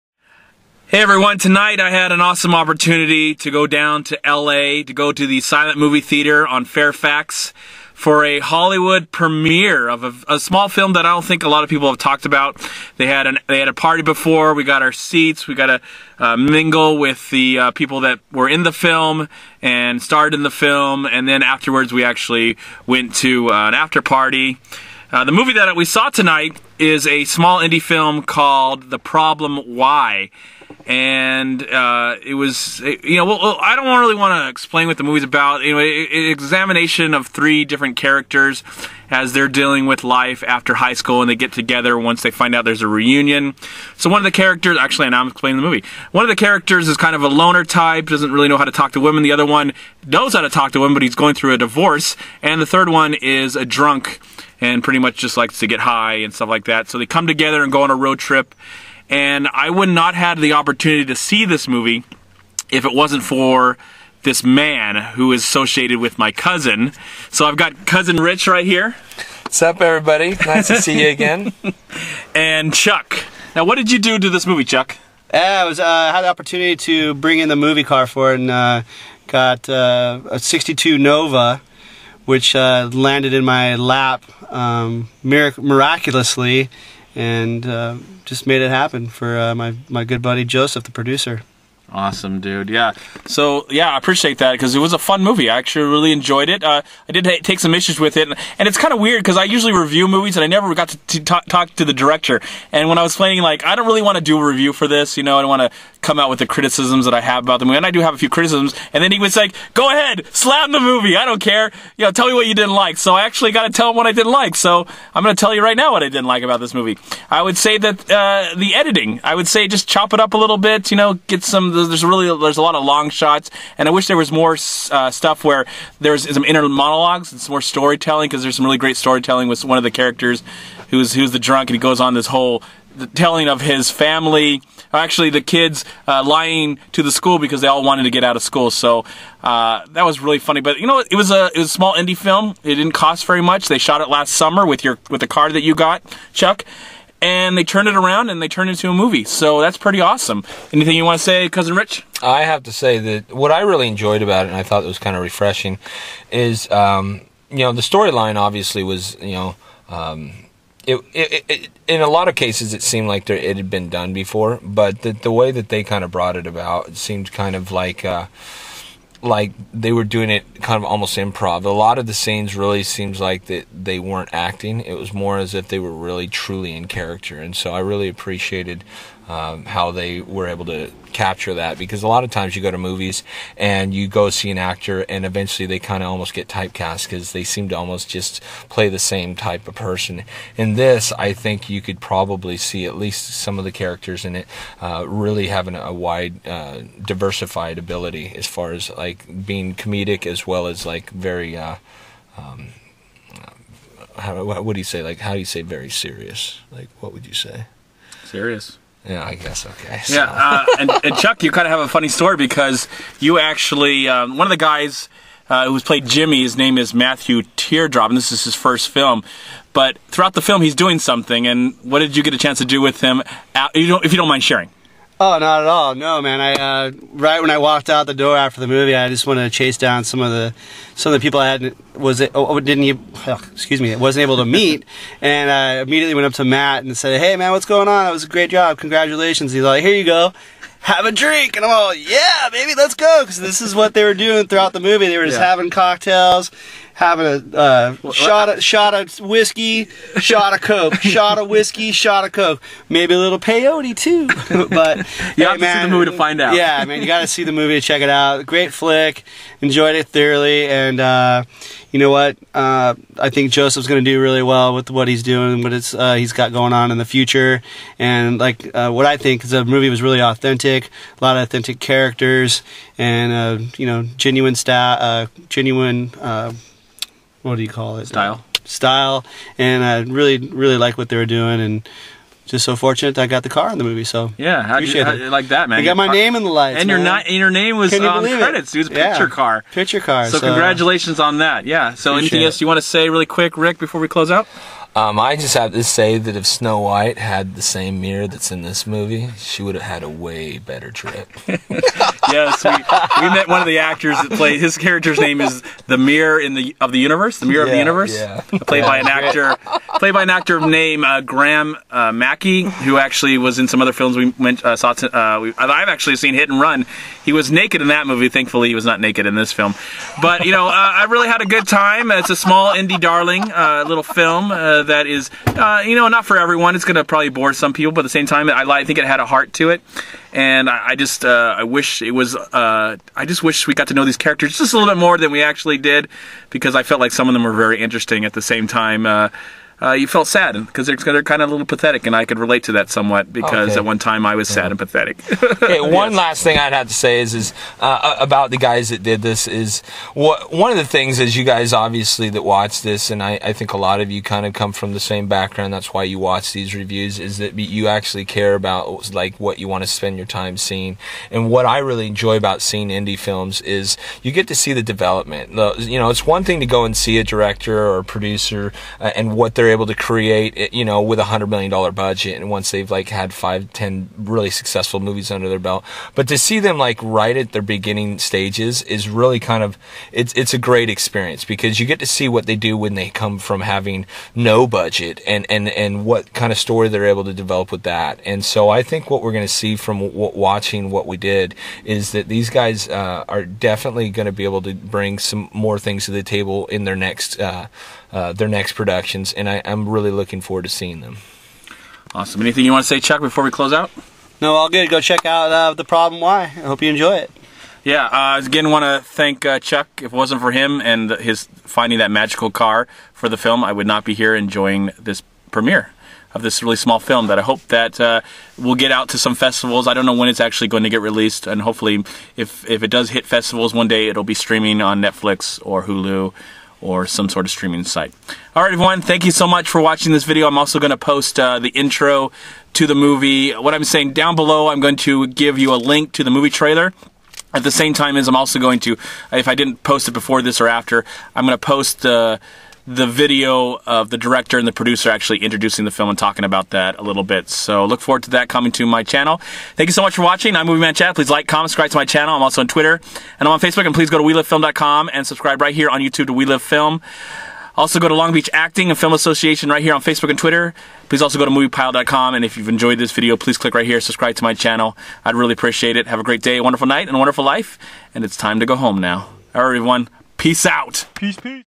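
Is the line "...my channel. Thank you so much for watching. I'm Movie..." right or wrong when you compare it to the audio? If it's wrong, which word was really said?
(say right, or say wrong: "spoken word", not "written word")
right.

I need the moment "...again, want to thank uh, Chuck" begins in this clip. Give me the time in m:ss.
6:48.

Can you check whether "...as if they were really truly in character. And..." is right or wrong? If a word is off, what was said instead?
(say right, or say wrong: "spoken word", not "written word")
right.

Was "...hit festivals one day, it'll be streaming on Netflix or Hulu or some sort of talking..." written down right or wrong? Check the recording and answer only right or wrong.
wrong.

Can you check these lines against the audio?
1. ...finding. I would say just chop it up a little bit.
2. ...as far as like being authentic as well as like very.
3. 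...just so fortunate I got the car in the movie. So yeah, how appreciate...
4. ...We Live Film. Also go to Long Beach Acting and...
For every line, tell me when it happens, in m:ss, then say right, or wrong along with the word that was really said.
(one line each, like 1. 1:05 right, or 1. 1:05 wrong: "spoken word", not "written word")
1. 1:58 wrong: "editing", not "finding"
2. 3:18 wrong: "comedic", not "authentic"
3. 4:42 right
4. 7:36 right.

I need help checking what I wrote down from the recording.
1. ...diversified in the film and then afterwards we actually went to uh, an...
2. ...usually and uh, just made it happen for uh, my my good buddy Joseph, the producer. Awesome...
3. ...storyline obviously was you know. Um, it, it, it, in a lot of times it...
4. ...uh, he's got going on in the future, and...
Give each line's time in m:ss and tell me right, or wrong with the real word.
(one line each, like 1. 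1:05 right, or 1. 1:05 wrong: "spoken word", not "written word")
1. 0:20 wrong: "starred", not "diversified"
2. 1:25 wrong: "miraculously", not "usually"
3. 2:37 wrong: "cases", not "times"
4. 4:25 right.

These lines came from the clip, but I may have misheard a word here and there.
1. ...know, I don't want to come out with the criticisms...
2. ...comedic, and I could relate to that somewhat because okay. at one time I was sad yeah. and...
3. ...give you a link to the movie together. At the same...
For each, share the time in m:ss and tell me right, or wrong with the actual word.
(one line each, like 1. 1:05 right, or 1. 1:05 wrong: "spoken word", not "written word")
1. 1:45 right
2. 5:41 wrong: "pathetic", not "comedic"
3. 7:15 wrong: "trailer", not "together".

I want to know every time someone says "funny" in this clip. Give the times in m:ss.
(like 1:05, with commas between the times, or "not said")
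2:20, 3:31.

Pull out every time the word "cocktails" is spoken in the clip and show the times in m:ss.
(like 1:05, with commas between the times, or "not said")
4:05.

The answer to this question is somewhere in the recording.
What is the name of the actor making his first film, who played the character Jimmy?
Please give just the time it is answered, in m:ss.
3:36.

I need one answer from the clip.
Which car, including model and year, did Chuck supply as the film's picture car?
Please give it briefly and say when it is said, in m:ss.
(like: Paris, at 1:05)
'62 Nova, at 1:20.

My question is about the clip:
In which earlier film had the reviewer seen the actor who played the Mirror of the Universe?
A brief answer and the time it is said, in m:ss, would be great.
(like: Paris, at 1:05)
Hit and Run, at 5:16.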